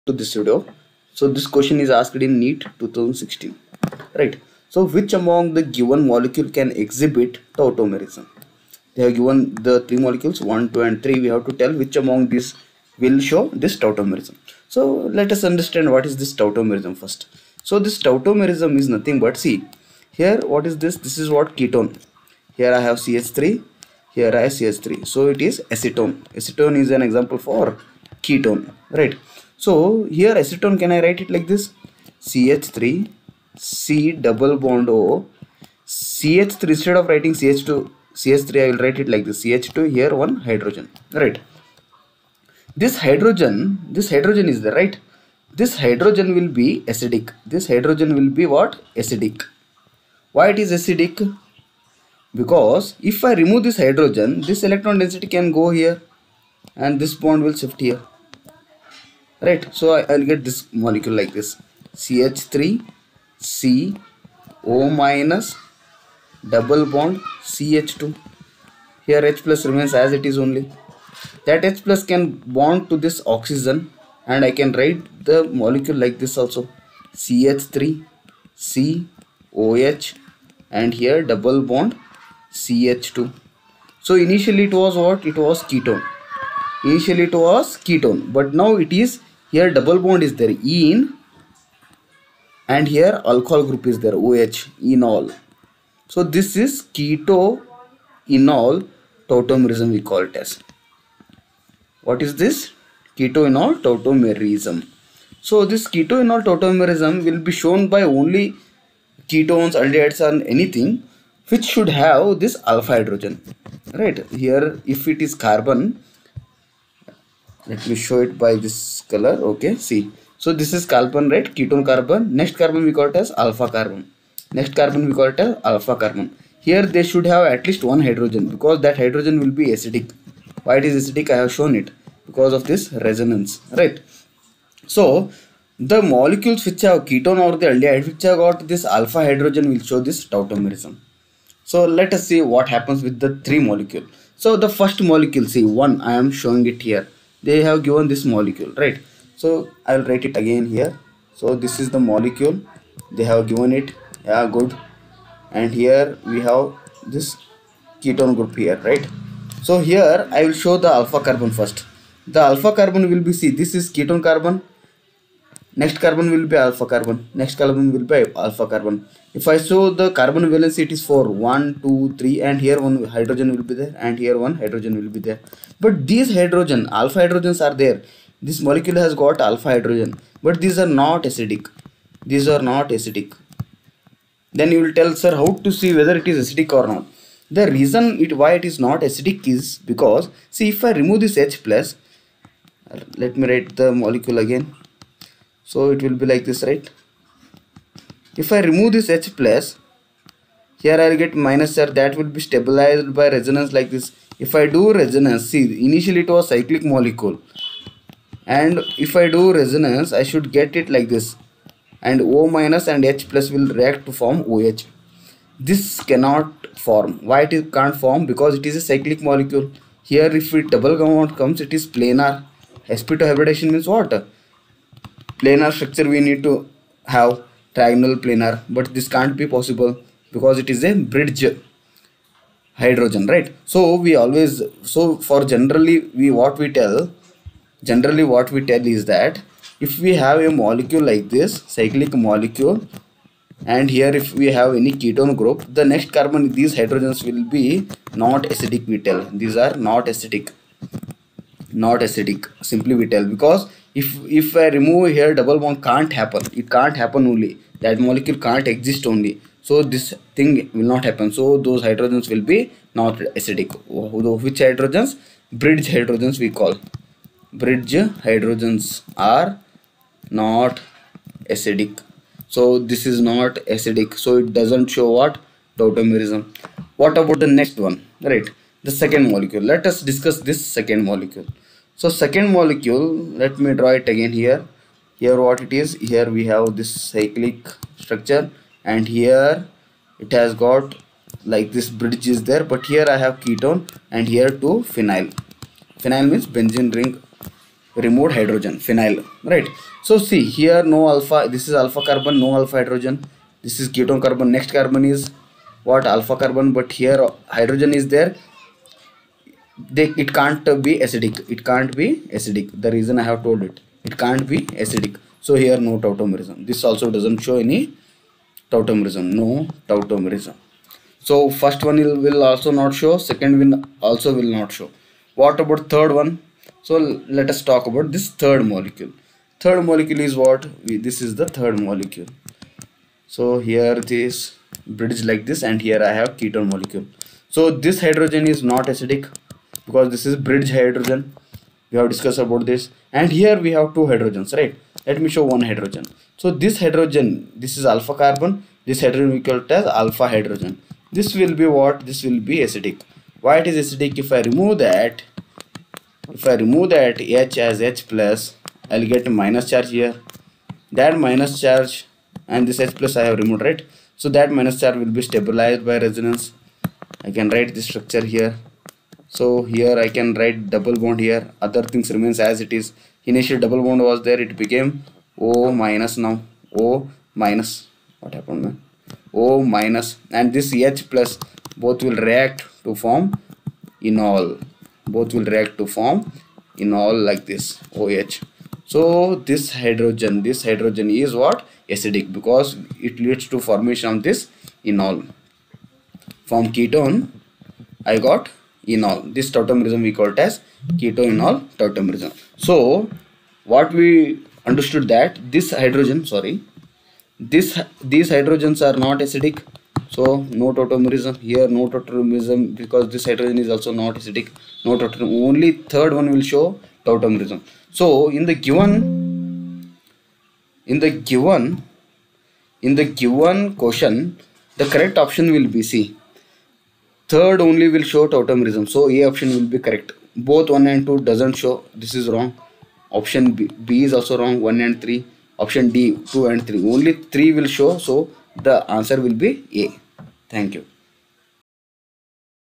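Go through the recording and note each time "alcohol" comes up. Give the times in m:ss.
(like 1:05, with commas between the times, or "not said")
1:33.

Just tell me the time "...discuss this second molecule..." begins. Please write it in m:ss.
4:40.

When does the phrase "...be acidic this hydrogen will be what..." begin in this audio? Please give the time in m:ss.
0:46.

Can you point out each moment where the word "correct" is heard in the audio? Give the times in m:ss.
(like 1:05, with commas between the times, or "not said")
7:04, 7:09.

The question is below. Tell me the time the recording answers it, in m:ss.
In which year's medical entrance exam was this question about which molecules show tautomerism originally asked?
0:02.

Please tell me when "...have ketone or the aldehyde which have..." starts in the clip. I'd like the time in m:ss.
2:16.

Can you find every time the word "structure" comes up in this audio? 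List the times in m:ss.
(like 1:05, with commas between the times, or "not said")
3:45, 4:48, 6:07.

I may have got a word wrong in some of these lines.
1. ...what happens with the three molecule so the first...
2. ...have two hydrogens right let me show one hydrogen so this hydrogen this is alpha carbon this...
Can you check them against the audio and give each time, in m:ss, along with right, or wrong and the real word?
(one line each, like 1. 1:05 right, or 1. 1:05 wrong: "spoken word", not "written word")
1. 2:22 right
2. 5:43 right.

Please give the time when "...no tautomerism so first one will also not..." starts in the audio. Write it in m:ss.
5:19.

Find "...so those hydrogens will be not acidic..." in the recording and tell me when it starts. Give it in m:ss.
4:21.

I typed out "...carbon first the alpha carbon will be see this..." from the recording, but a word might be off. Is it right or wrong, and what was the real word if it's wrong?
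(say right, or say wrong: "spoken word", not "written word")
right.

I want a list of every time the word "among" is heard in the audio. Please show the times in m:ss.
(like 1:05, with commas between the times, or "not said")
0:05, 0:12.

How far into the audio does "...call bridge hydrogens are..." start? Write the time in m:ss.
4:26.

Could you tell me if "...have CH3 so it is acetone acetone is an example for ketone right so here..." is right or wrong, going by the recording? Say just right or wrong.
right.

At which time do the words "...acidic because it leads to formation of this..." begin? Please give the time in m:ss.
6:31.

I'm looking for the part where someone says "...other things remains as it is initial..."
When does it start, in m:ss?
6:11.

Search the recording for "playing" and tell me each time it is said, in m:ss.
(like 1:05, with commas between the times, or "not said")
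not said.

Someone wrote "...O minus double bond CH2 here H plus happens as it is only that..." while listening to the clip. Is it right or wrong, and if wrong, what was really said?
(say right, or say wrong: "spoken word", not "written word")
wrong: "remains", not "happens".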